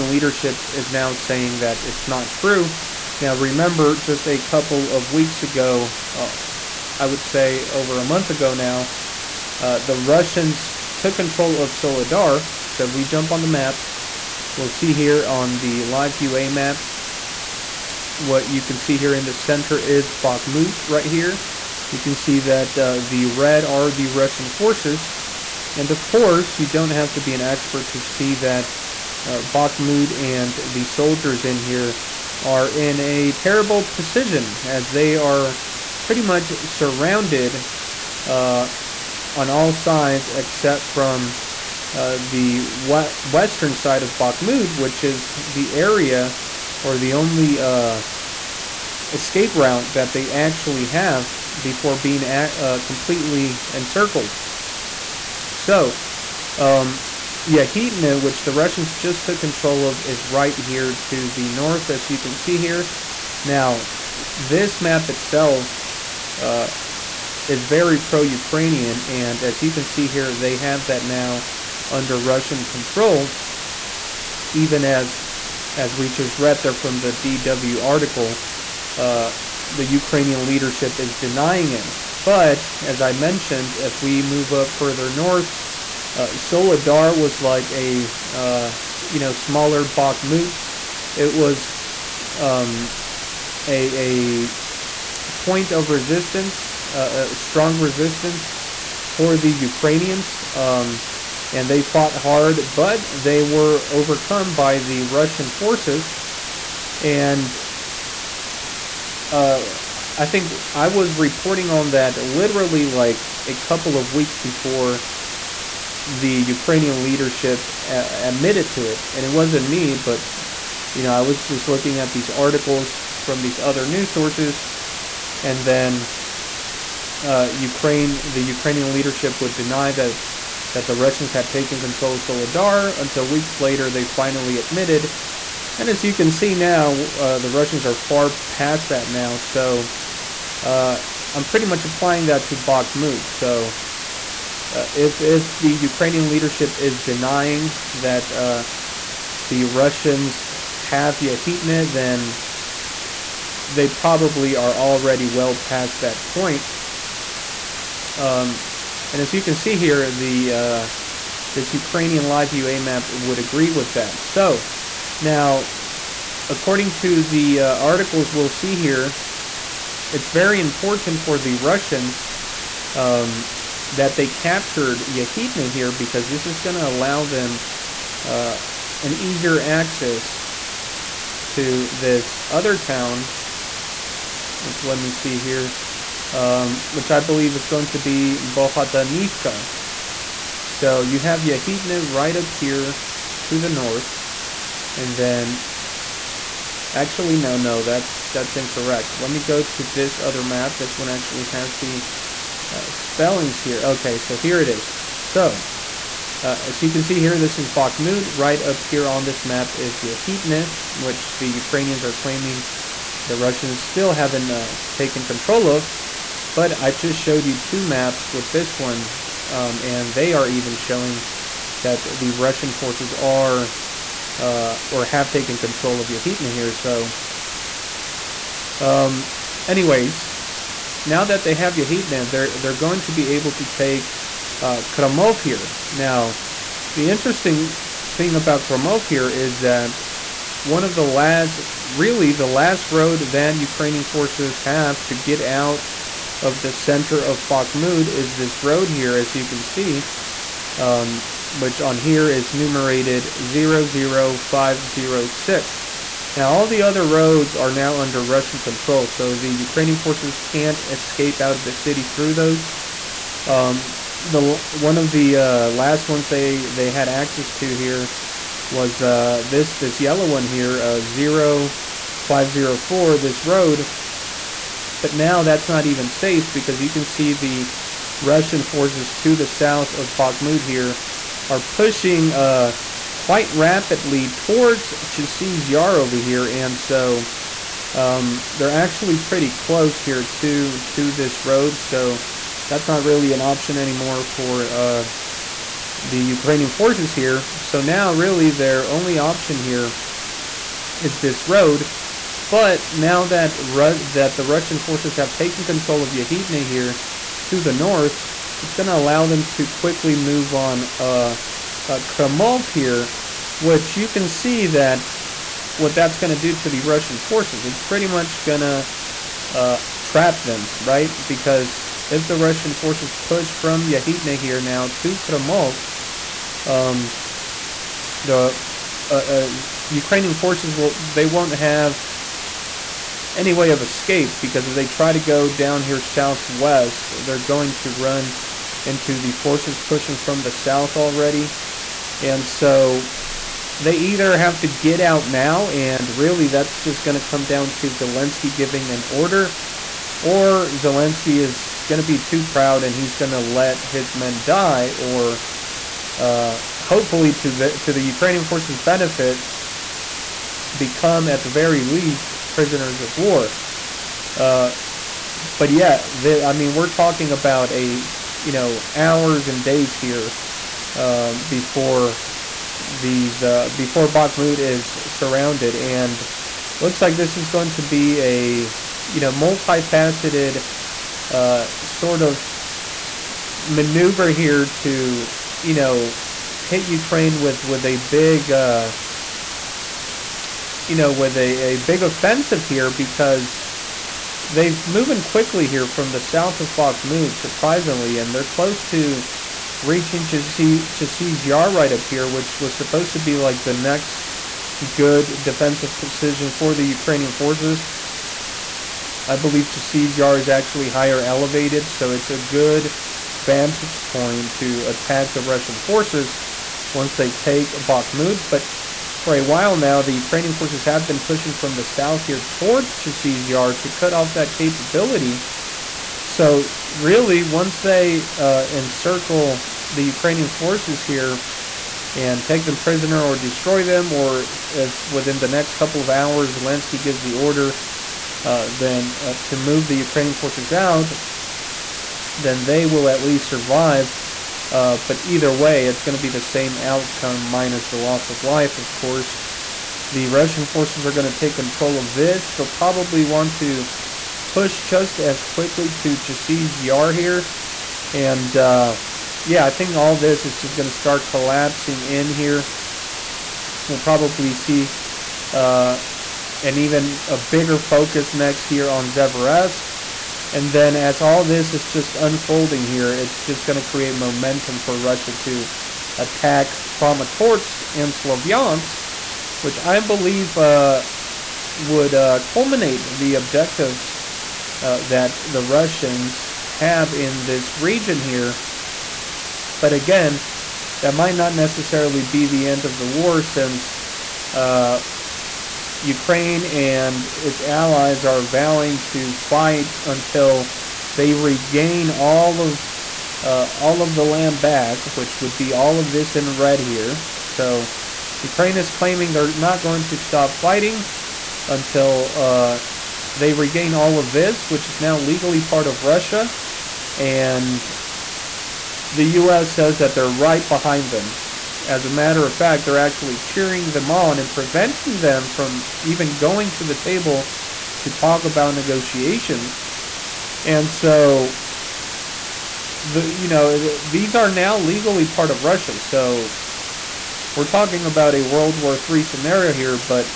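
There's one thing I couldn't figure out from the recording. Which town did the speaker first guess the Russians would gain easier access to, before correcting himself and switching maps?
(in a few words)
Bohdanivka.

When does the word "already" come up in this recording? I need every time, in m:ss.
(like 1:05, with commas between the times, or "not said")
2:34, 5:40.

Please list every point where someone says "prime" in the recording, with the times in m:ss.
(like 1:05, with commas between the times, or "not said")
not said.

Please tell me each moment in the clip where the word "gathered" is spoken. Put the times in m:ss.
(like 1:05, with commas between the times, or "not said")
not said.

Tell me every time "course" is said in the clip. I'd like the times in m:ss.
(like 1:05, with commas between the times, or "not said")
0:26, 7:28.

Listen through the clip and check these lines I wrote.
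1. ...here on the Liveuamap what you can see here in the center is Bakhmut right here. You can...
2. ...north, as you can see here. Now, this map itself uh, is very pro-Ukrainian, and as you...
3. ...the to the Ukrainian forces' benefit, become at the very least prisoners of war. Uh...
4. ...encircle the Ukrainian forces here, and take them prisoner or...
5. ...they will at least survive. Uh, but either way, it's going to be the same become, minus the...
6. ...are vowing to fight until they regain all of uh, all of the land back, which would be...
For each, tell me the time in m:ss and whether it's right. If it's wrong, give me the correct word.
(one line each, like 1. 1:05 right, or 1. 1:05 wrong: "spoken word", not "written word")
1. 0:14 right
2. 1:01 right
3. 5:57 right
4. 7:08 right
5. 7:22 wrong: "outcome", not "become"
6. 8:18 right.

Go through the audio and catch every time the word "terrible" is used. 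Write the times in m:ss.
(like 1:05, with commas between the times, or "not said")
0:33.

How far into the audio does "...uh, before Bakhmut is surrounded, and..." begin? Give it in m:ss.
6:13.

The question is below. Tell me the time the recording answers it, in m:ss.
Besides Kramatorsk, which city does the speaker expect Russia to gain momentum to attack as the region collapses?
7:58.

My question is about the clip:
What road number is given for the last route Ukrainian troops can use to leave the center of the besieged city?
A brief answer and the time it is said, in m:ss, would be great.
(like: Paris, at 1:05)
00506, at 4:14.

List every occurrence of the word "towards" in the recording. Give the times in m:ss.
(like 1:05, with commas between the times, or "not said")
4:44, 7:02.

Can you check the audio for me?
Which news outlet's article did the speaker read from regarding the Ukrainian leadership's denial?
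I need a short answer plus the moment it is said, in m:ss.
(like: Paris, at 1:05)
DW, at 1:17.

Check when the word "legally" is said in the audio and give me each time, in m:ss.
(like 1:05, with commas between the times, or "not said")
8:35, 8:54.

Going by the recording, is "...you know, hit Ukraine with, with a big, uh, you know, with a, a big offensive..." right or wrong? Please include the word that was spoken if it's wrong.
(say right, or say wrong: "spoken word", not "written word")
right.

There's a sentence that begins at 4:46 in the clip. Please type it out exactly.
And so um, they're actually pretty close here to, to this road.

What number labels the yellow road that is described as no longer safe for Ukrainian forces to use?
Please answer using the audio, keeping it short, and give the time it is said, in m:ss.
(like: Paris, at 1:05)
0504, at 4:31.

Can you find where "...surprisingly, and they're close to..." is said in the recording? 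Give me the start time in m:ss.
6:37.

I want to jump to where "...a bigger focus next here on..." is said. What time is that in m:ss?
7:47.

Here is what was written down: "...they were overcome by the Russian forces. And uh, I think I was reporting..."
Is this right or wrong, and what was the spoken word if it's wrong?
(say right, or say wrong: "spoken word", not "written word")
right.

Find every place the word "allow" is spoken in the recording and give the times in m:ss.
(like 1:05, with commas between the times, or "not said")
2:56, 5:08.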